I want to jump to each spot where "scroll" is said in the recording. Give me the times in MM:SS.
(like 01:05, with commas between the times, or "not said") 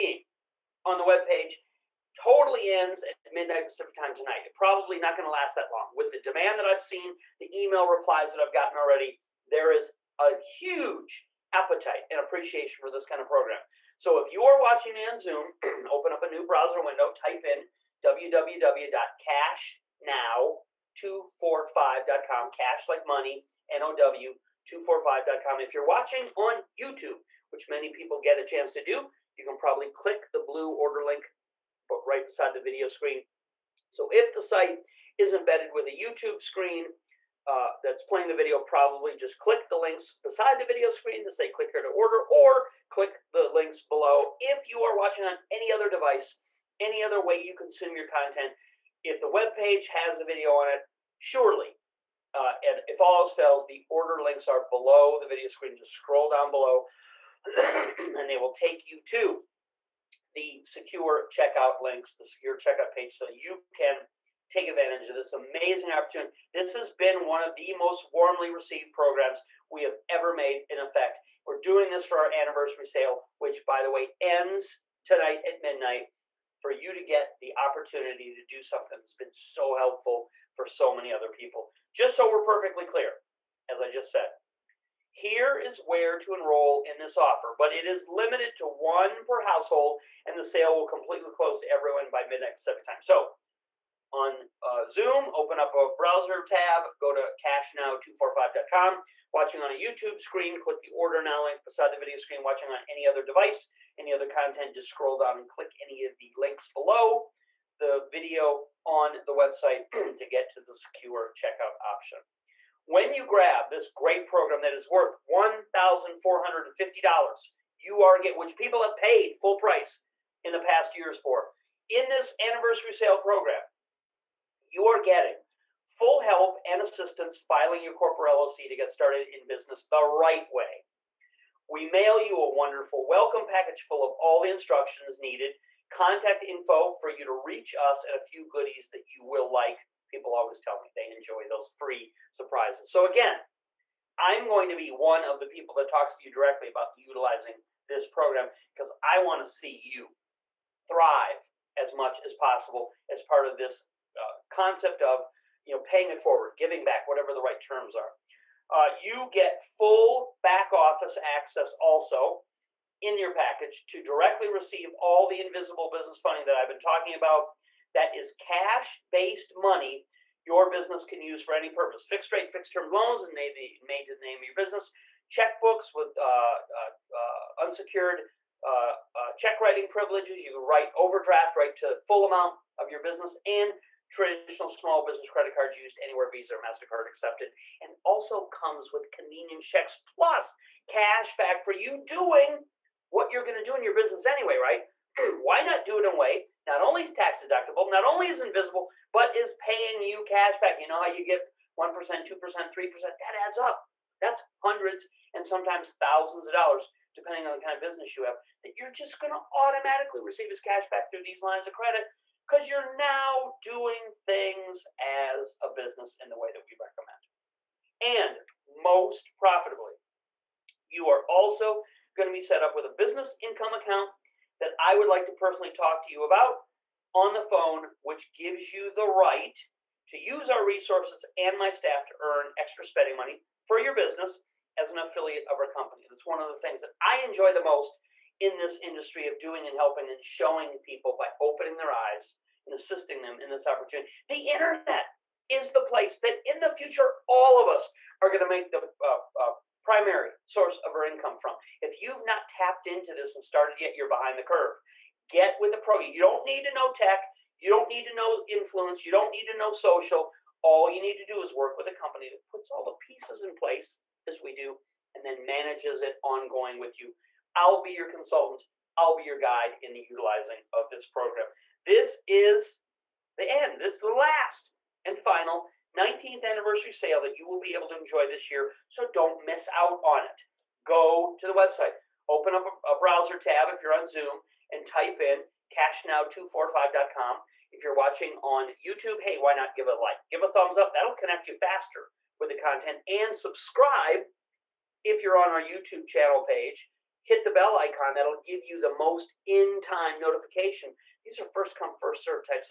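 00:55, 01:44.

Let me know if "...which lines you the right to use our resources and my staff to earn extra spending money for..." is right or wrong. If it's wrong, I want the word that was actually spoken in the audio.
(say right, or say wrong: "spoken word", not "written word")
wrong: "gives", not "lines".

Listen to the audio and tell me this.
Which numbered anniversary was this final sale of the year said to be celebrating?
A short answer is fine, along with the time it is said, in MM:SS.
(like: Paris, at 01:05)
19th, at 04:35.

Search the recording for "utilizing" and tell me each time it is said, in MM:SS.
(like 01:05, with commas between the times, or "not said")
02:26, 04:30.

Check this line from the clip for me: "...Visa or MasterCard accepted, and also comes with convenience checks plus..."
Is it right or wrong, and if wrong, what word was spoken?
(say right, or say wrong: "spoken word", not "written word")
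right.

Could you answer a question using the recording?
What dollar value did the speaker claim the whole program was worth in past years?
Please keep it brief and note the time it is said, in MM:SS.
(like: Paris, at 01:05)
$1,450, at 01:55.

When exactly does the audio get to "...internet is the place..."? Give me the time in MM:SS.
04:04.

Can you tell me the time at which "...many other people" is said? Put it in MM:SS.
01:20.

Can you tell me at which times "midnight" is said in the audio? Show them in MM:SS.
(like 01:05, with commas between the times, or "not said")
00:03, 01:15, 01:32.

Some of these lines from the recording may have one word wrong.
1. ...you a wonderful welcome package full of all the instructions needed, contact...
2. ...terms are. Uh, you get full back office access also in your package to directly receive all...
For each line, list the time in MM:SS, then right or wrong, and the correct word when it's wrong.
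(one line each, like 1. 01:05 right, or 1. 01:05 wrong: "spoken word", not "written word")
1. 02:12 right
2. 02:37 right.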